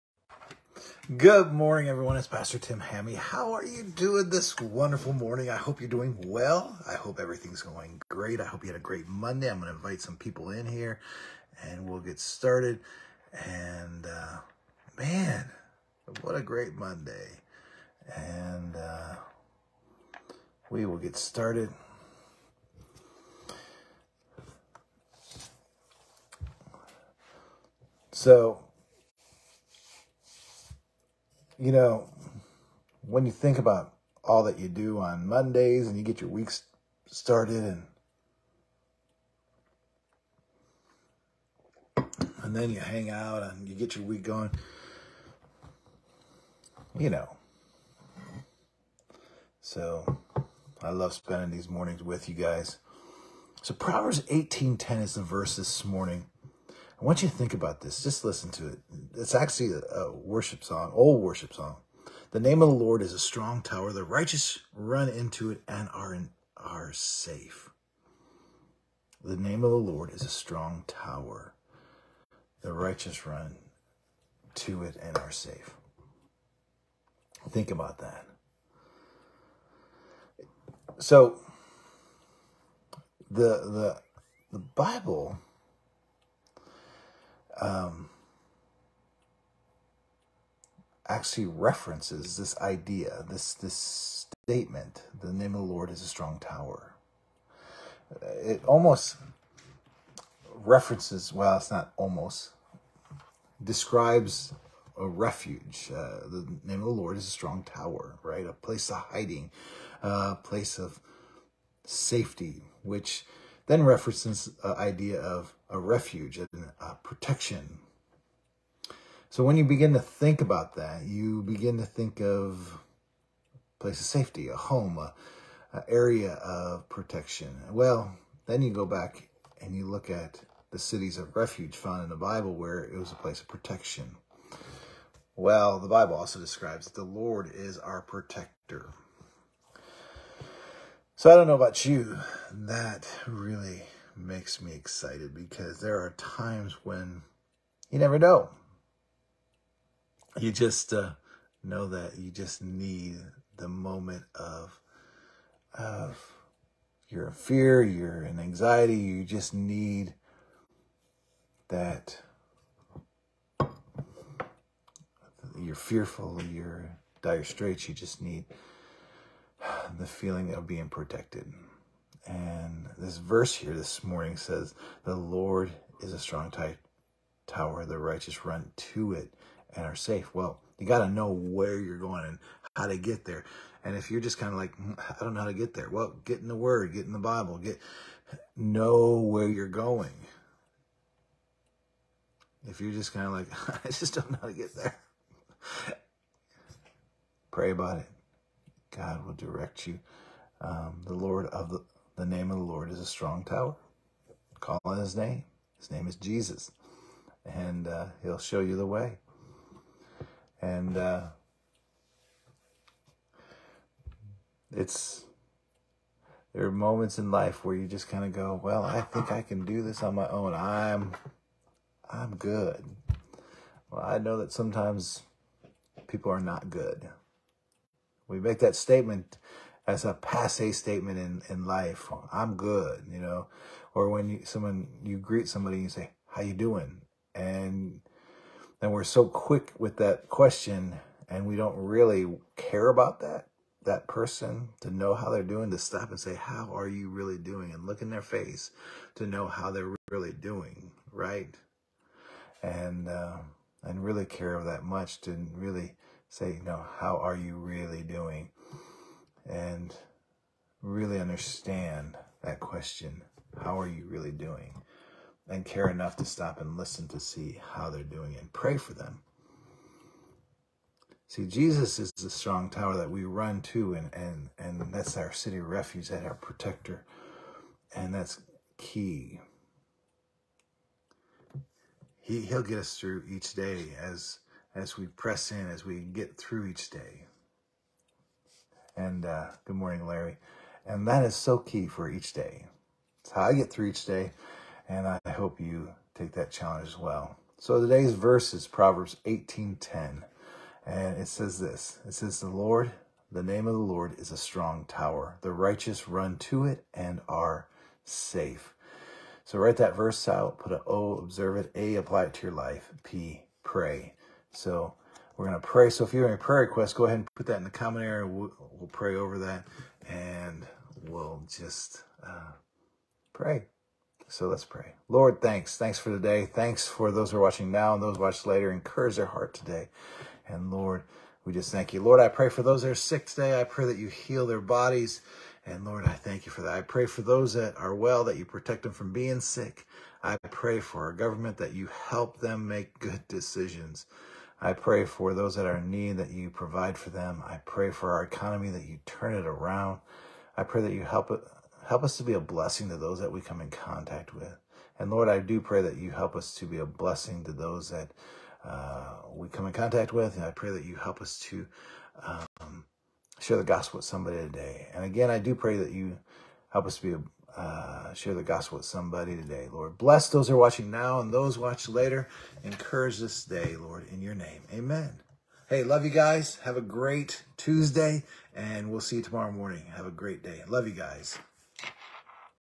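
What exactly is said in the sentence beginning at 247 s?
And look in their face to know how they're really doing.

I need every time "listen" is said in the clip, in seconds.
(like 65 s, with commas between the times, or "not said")
58 s, 266 s.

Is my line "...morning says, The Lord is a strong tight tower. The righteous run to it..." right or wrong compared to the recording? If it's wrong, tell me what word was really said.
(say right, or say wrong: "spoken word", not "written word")
right.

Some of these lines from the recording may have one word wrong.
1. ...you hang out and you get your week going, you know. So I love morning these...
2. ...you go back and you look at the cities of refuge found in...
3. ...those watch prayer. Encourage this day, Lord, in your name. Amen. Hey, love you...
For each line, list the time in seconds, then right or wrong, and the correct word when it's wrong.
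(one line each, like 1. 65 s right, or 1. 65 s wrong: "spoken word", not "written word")
1. 42 s wrong: "spending", not "morning"
2. 128 s right
3. 371 s wrong: "later", not "prayer".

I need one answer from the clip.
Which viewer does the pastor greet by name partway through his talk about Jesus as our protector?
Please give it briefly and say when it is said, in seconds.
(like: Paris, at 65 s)
Larry, at 290 s.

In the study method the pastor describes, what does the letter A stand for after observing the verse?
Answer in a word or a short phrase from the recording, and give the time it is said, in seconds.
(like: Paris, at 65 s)
apply, at 311 s.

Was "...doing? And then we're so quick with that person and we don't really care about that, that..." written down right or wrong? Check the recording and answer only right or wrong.
wrong.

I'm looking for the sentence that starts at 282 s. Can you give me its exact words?
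He, he'll get us through each day as, as we press in, as we get through each day.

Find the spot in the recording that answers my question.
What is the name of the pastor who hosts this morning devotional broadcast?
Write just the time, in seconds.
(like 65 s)
2 s.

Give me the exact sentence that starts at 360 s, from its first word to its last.
And I pray that you help us to um, share the gospel with somebody today.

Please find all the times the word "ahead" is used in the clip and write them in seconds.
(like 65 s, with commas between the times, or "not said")
317 s.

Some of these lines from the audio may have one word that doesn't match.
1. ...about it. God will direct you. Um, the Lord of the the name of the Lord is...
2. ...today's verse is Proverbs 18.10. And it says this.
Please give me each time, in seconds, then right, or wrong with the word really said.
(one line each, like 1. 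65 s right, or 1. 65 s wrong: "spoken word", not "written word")
1. 197 s right
2. 297 s right.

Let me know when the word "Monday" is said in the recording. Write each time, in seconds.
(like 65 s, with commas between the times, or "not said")
9 s, 16 s, 35 s.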